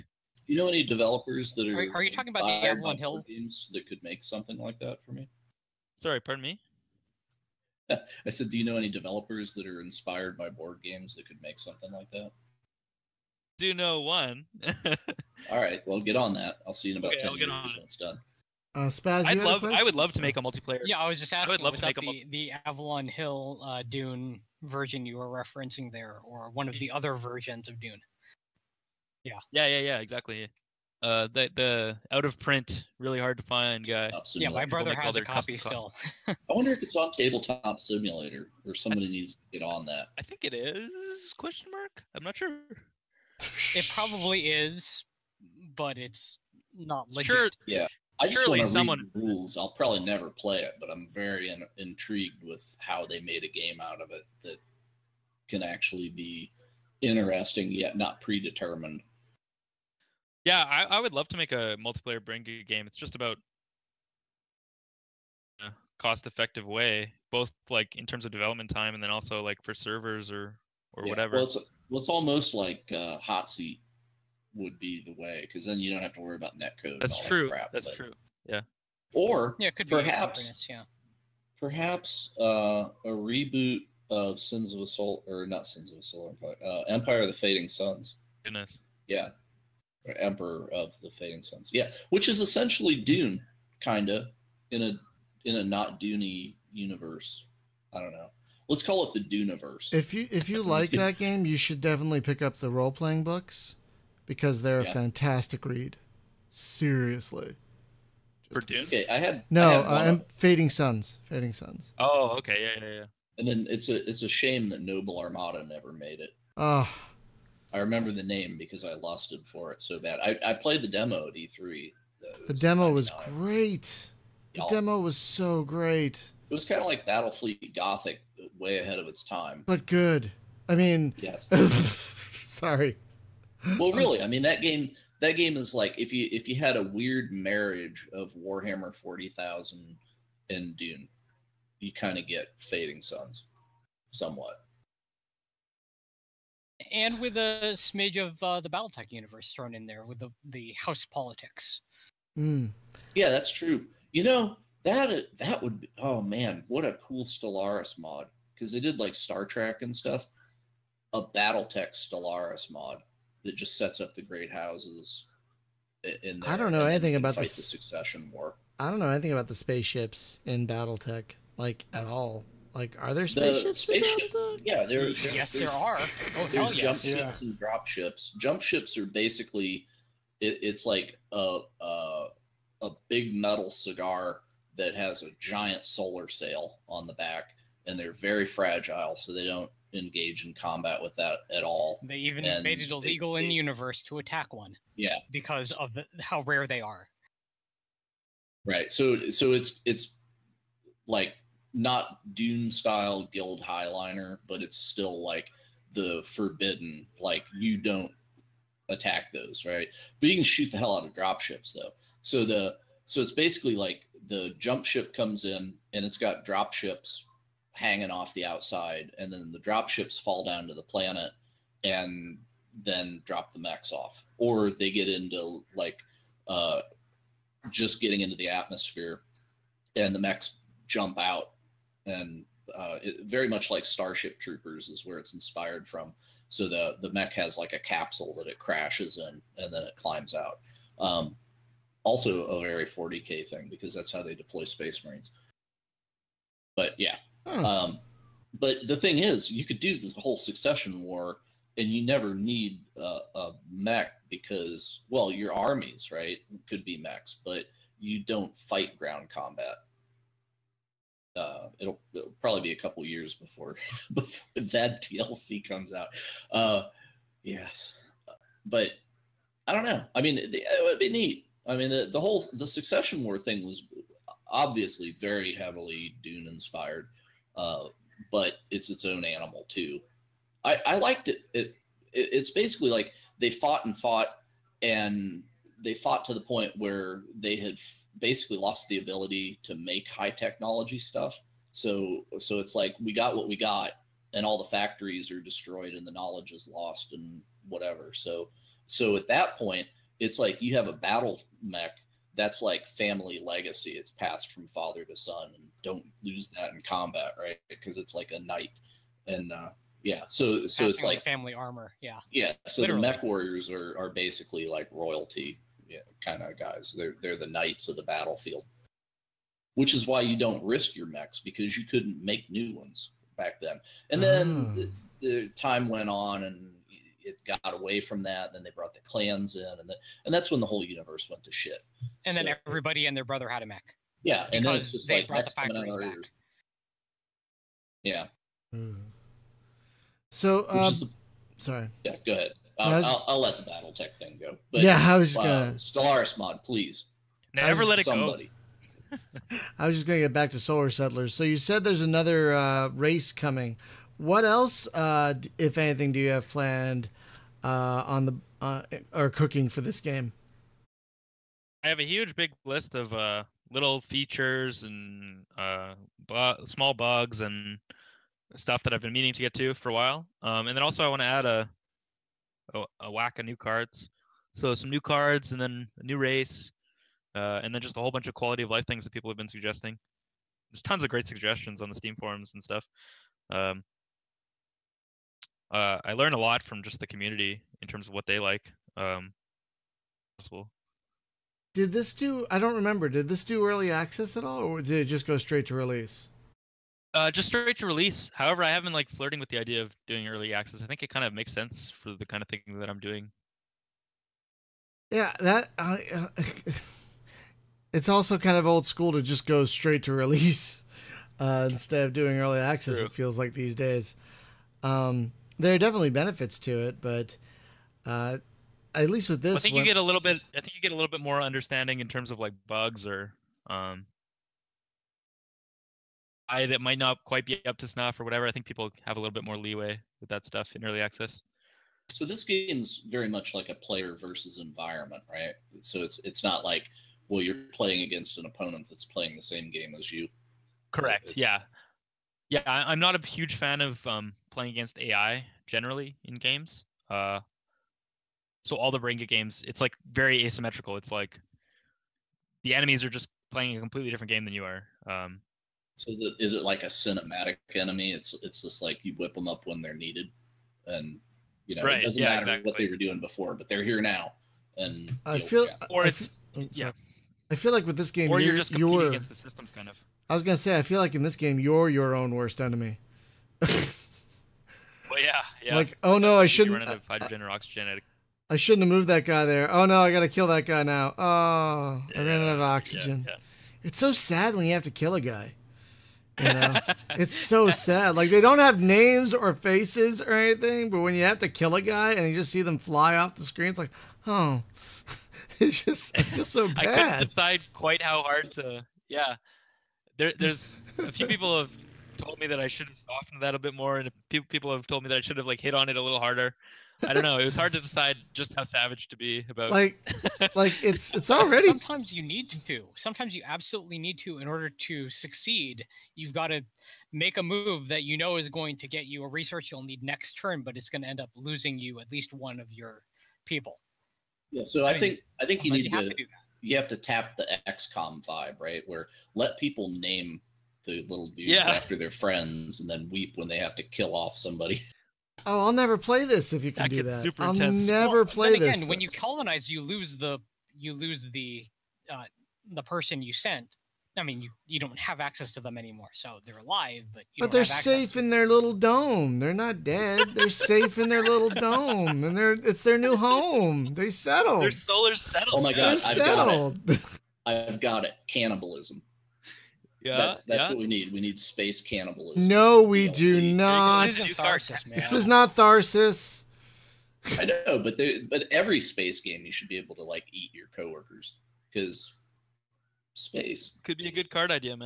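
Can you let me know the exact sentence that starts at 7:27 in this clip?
Uh, so all the Brain Good games, it's like very asymmetrical.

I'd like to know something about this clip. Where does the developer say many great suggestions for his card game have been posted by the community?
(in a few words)
Steam forums.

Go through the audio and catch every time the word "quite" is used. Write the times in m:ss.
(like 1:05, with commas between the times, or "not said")
7:07, 8:17.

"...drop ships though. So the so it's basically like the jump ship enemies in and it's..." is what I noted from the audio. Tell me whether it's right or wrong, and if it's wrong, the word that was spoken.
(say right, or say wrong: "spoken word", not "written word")
wrong: "comes", not "enemies".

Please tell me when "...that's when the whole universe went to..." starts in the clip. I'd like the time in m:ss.
5:30.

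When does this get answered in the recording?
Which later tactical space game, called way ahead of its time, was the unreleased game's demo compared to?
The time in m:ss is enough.
2:07.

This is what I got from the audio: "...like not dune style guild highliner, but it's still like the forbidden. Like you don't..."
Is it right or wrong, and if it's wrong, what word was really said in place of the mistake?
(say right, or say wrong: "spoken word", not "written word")
right.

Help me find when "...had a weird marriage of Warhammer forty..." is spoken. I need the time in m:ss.
2:16.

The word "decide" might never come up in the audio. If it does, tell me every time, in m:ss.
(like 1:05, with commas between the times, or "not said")
8:17, 8:27.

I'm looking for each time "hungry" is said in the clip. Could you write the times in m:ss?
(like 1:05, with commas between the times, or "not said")
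not said.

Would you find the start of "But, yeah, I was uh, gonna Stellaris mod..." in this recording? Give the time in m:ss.
5:44.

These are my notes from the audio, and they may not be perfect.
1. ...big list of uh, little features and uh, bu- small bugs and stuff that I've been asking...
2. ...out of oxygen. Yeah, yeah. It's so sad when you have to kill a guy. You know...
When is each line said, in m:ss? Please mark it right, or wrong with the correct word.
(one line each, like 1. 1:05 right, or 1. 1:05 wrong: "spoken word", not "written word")
1. 6:02 wrong: "meaning", not "asking"
2. 8:02 right.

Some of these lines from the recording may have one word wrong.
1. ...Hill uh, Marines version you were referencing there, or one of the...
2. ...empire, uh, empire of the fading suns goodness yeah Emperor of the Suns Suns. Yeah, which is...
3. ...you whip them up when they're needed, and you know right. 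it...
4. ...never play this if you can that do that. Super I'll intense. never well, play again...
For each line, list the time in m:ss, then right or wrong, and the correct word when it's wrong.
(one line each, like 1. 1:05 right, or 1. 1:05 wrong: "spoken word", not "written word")
1. 0:23 wrong: "Dune", not "Marines"
2. 1:26 wrong: "Fading", not "Suns"
3. 7:39 right
4. 8:55 right.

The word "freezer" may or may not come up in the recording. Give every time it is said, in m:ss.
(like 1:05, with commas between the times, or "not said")
not said.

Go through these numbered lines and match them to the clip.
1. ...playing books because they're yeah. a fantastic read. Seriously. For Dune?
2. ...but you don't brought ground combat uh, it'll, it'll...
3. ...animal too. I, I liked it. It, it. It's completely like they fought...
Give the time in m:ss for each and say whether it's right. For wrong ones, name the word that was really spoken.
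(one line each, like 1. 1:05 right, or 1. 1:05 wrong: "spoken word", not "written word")
1. 1:42 right
2. 4:17 wrong: "fight", not "brought"
3. 4:39 wrong: "basically", not "completely".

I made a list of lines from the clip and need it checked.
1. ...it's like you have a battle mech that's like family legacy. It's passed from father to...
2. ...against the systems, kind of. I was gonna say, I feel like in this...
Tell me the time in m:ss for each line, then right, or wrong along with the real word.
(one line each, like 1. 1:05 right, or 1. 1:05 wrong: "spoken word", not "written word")
1. 5:00 right
2. 7:49 right.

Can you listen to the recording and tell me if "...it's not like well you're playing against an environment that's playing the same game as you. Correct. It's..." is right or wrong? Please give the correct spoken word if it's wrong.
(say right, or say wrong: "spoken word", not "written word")
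wrong: "opponent", not "environment".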